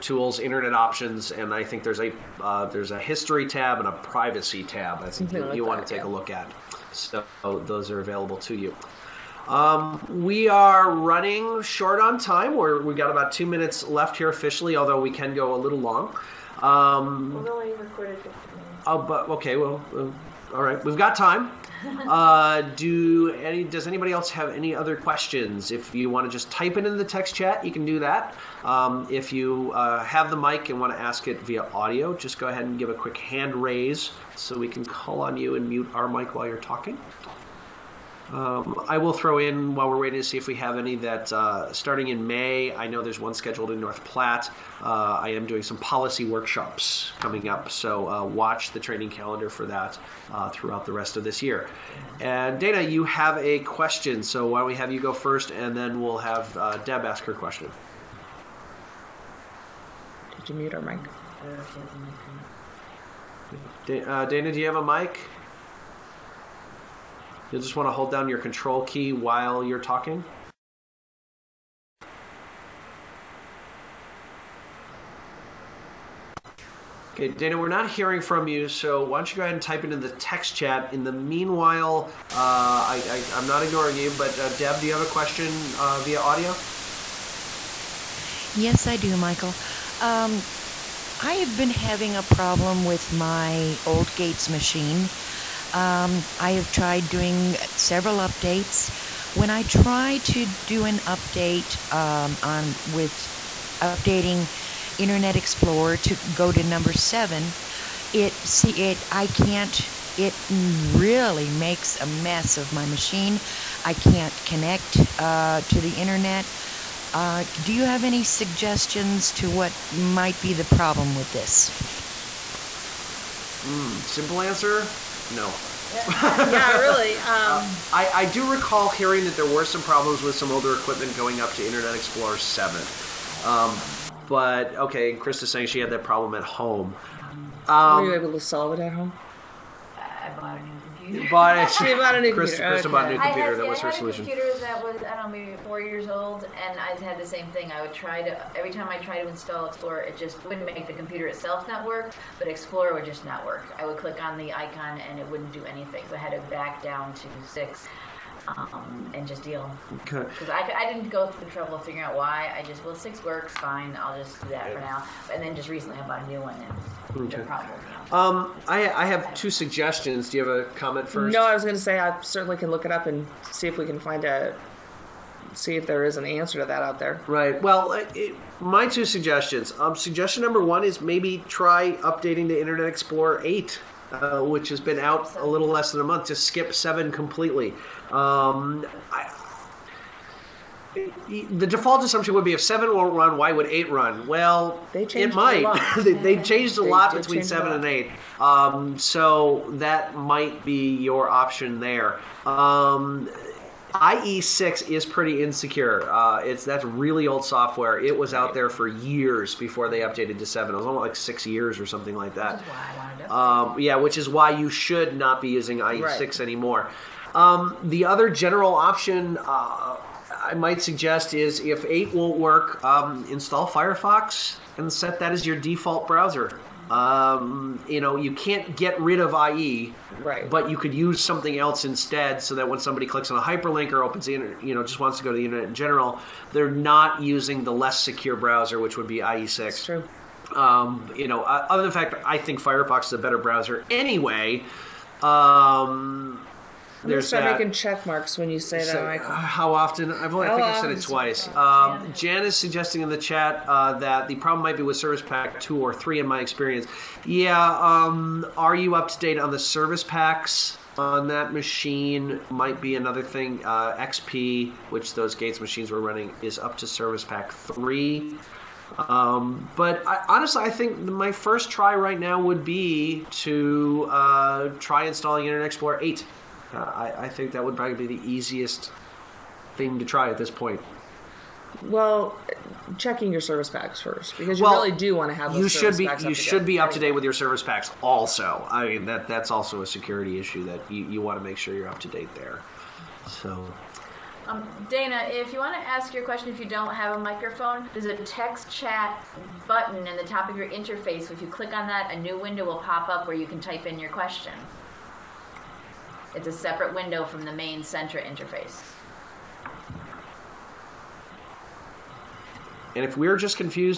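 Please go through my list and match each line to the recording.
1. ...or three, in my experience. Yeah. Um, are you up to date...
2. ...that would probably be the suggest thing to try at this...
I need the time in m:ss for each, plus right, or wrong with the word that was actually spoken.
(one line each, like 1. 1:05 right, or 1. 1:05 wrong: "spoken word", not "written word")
1. 4:15 right
2. 4:37 wrong: "easiest", not "suggest".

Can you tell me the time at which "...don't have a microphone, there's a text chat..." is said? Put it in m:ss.
4:56.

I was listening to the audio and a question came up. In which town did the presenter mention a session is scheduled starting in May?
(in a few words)
North Platte.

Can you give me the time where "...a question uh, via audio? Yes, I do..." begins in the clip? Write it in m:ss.
1:25.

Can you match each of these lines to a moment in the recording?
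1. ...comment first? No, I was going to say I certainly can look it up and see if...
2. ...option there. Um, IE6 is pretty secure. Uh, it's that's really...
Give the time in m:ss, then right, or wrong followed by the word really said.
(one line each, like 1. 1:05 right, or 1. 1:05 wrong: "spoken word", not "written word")
1. 2:50 right
2. 3:21 wrong: "insecure", not "secure".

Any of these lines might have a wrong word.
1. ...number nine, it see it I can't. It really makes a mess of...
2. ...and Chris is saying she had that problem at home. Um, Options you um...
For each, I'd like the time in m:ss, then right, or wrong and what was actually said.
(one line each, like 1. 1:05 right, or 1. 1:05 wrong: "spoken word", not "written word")
1. 1:46 wrong: "seven", not "nine"
2. 2:15 wrong: "Were", not "Options".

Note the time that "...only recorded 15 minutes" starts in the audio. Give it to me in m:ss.
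0:17.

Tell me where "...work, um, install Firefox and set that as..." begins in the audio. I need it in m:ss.
3:42.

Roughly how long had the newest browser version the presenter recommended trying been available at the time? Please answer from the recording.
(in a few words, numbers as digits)
a little less than a month.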